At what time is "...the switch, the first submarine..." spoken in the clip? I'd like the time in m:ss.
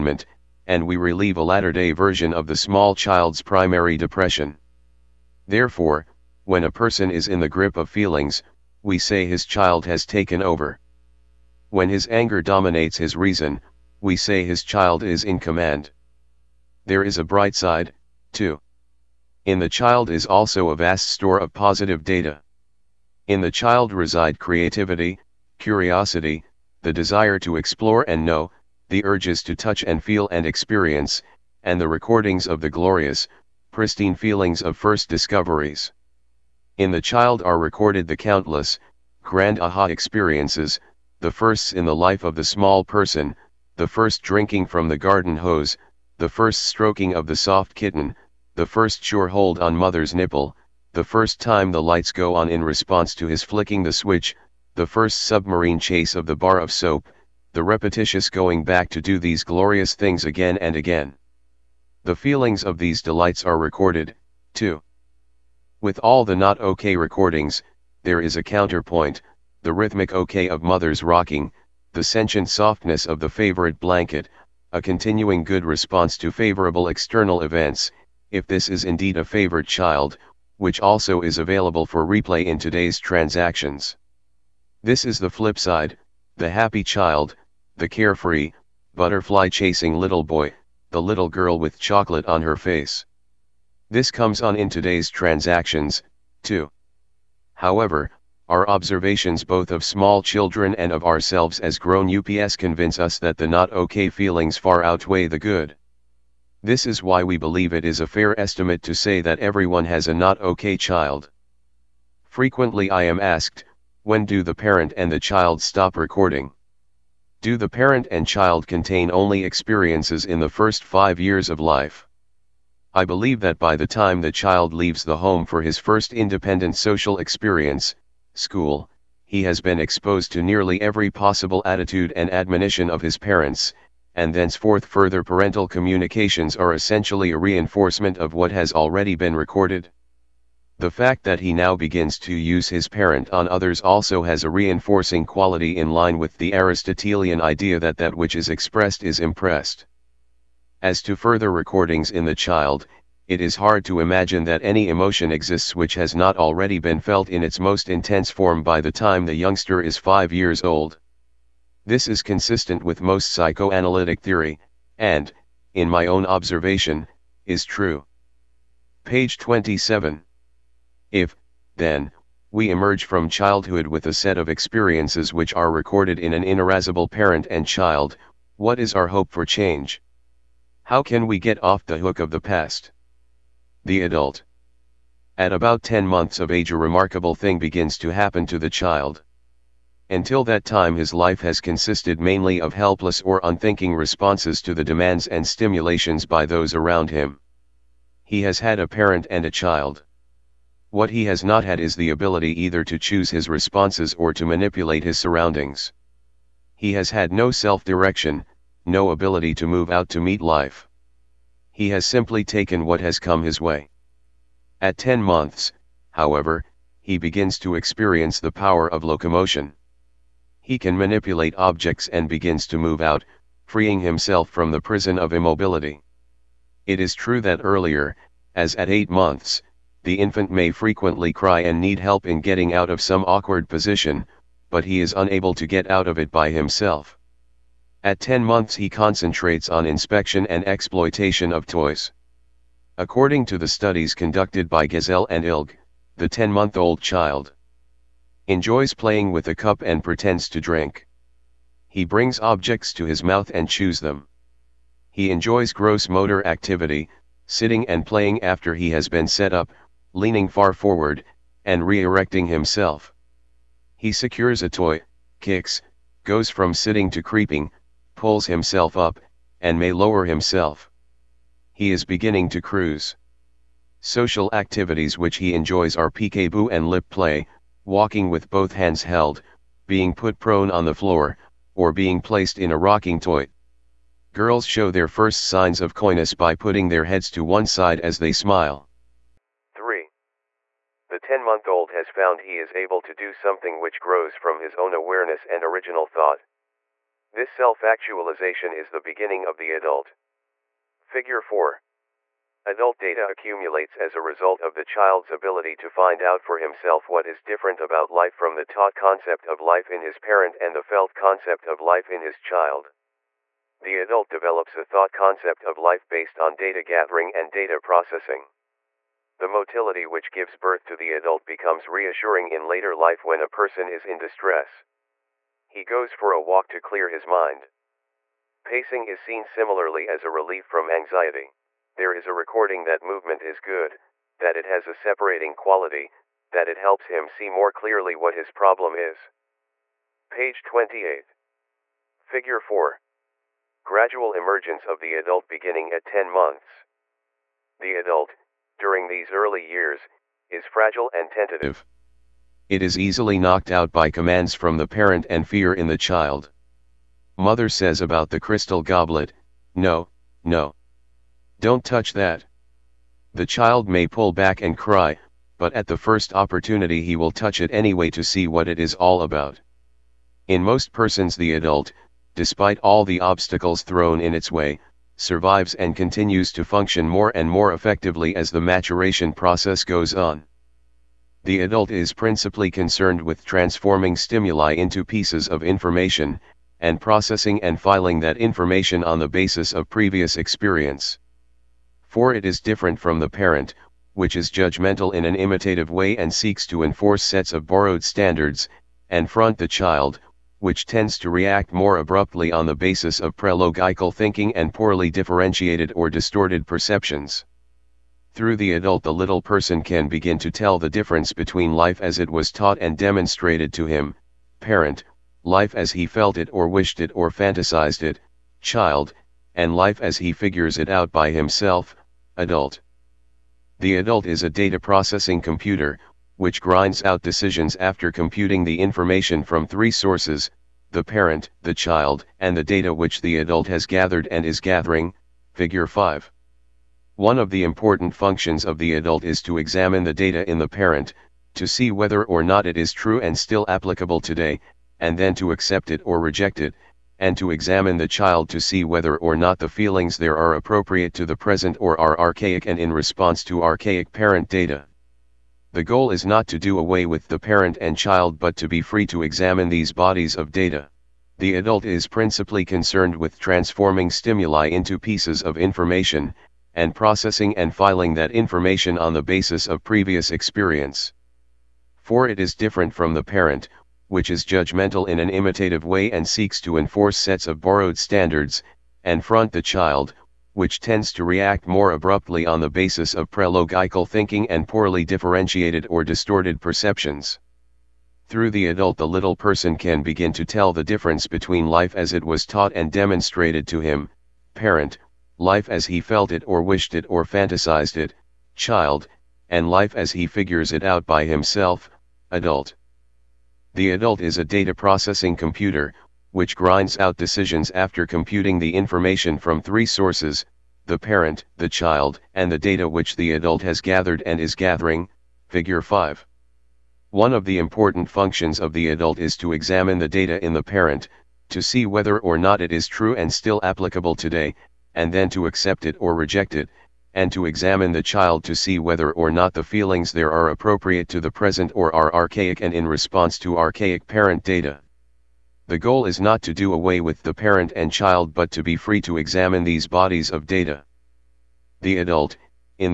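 0:53.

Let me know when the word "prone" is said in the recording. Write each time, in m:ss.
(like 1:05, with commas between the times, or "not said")
4:40.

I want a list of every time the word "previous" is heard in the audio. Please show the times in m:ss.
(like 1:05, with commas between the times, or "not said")
6:29, 7:49.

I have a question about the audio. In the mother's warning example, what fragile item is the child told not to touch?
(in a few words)
crystal goblet.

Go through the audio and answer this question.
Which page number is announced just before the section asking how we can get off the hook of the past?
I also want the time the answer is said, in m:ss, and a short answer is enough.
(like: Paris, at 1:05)
27, at 2:49.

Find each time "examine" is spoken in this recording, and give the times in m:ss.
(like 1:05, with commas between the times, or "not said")
7:19, 7:27, 7:39, 8:39, 8:47, 8:59.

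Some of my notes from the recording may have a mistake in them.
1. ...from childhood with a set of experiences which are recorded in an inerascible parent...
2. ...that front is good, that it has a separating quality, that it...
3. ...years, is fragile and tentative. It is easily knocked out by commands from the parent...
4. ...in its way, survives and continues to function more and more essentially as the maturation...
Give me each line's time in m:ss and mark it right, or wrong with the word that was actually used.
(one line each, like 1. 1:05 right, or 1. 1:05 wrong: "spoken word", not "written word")
1. 2:53 right
2. 5:32 wrong: "movement", not "front"
3. 5:49 right
4. 6:14 wrong: "effectively", not "essentially".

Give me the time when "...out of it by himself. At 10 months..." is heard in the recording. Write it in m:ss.
3:55.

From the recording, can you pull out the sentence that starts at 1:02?
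The feelings of these delights are recorded, too.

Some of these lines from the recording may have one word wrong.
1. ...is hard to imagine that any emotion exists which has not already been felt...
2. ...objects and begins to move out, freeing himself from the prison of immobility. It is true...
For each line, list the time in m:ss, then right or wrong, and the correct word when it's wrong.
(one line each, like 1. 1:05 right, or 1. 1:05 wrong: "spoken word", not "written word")
1. 2:33 right
2. 3:41 right.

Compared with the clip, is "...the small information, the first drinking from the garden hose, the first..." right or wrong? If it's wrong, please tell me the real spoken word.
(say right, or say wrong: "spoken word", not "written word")
wrong: "person", not "information".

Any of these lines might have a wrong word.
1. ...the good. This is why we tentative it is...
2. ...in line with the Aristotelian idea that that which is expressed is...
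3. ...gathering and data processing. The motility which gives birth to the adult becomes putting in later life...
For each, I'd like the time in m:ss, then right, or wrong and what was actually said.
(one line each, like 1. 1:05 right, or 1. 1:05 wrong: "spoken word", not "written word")
1. 1:45 wrong: "believe", not "tentative"
2. 2:25 right
3. 5:16 wrong: "reassuring", not "putting".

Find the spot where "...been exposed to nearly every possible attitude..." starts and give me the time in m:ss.
2:09.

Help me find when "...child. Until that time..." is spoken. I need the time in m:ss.
3:08.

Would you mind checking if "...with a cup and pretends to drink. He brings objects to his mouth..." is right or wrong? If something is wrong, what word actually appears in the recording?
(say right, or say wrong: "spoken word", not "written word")
right.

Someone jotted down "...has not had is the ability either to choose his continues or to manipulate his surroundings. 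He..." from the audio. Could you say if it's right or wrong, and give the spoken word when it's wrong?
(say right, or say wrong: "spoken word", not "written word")
wrong: "responses", not "continues".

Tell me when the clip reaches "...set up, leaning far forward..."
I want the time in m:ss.
4:19.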